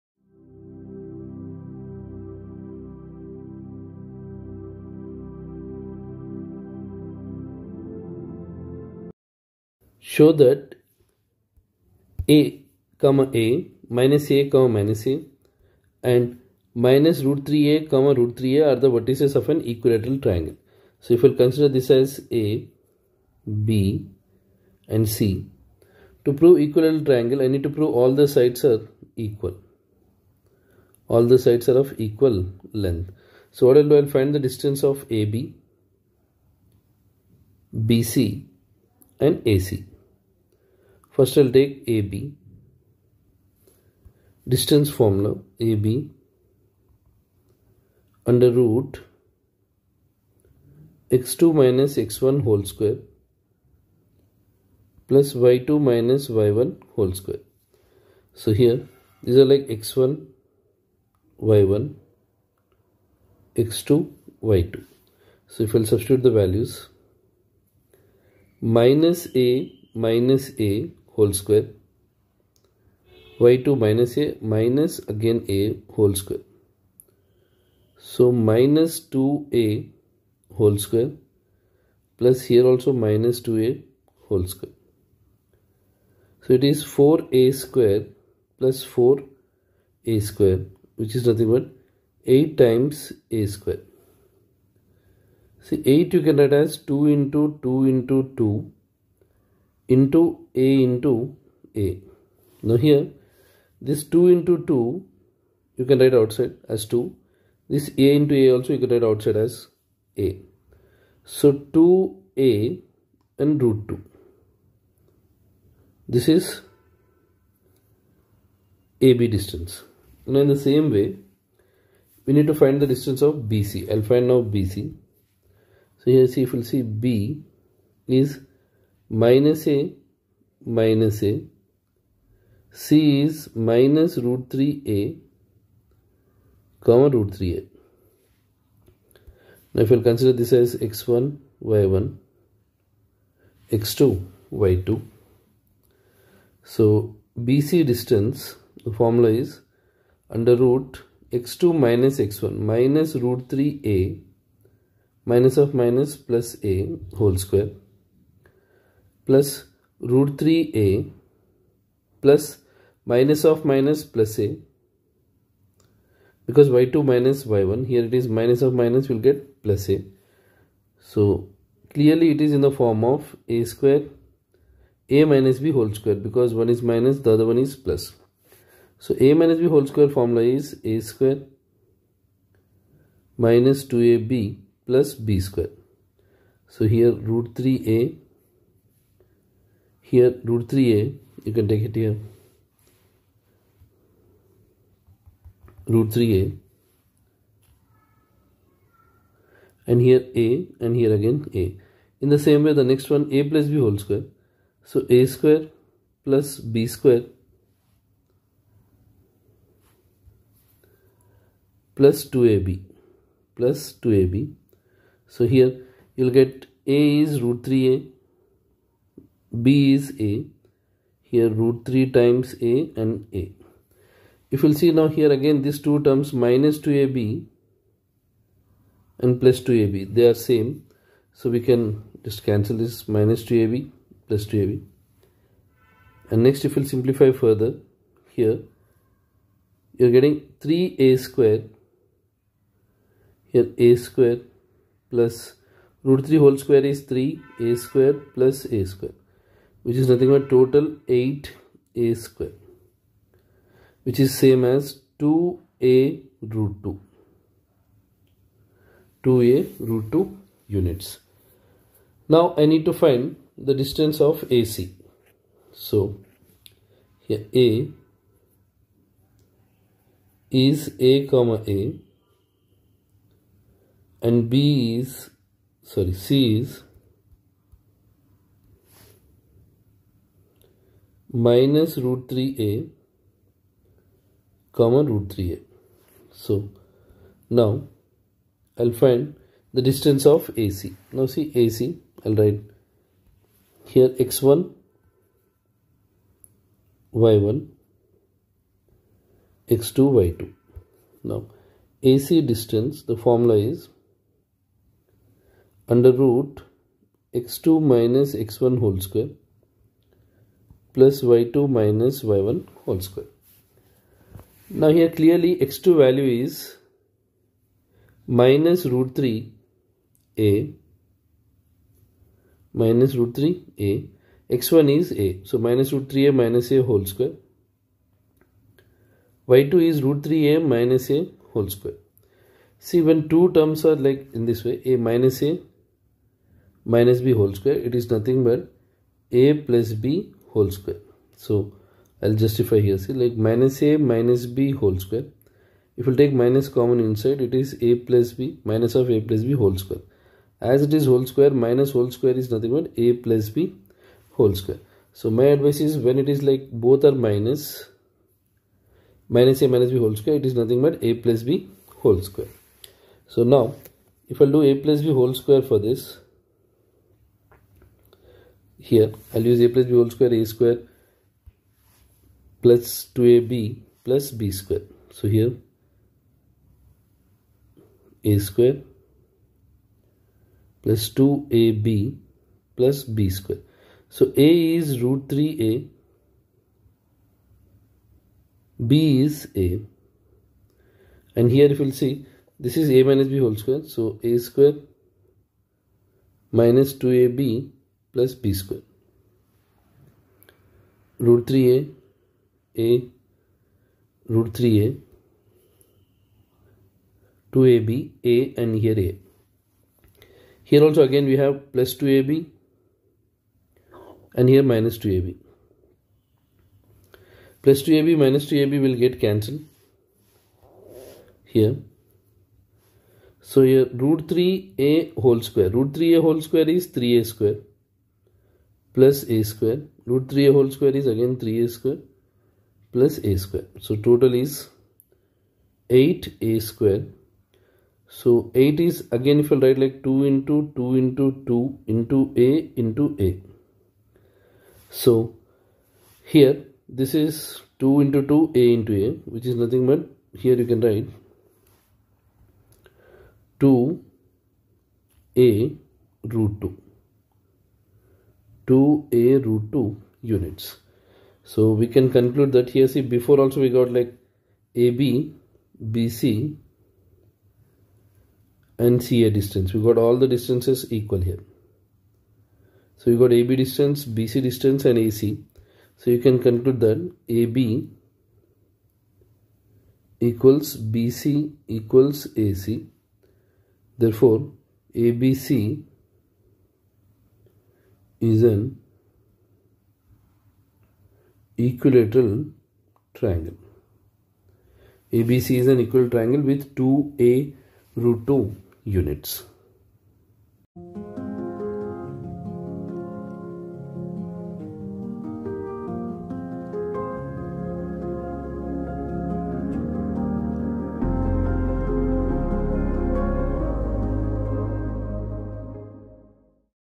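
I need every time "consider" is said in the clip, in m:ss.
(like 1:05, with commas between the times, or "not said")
0:21, 2:20.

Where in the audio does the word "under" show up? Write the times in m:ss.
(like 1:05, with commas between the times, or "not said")
0:48, 2:30, 5:05.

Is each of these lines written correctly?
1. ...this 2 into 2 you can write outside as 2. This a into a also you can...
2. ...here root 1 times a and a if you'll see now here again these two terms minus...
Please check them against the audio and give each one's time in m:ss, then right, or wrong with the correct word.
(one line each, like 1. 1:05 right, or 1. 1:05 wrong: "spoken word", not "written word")
1. 1:43 right
2. 3:41 wrong: "3", not "1".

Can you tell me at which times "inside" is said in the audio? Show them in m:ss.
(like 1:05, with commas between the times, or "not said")
5:46.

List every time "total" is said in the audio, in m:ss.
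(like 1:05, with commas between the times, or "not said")
4:10, 7:14.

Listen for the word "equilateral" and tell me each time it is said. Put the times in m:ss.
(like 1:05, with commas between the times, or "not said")
0:19, 0:26, 8:11, 8:15.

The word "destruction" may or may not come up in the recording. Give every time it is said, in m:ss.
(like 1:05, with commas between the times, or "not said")
not said.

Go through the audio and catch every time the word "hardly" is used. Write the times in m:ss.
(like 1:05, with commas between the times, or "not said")
not said.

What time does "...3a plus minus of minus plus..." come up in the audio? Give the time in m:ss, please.
2:40.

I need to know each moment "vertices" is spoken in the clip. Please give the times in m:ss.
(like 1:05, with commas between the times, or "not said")
0:18.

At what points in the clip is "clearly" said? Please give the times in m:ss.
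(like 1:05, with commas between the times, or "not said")
2:51, 5:15.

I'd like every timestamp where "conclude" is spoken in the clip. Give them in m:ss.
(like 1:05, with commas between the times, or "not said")
7:42, 7:56.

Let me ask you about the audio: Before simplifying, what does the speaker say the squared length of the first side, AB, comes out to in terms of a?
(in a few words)
8a².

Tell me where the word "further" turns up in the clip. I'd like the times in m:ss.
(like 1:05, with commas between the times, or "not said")
3:57.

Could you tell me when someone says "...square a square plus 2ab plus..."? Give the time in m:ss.
6:10.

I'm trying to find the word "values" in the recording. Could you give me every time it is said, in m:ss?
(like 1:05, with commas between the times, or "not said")
1:06, 5:15.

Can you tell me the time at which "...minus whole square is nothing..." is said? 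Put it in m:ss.
5:51.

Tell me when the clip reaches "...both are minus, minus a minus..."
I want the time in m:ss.
5:56.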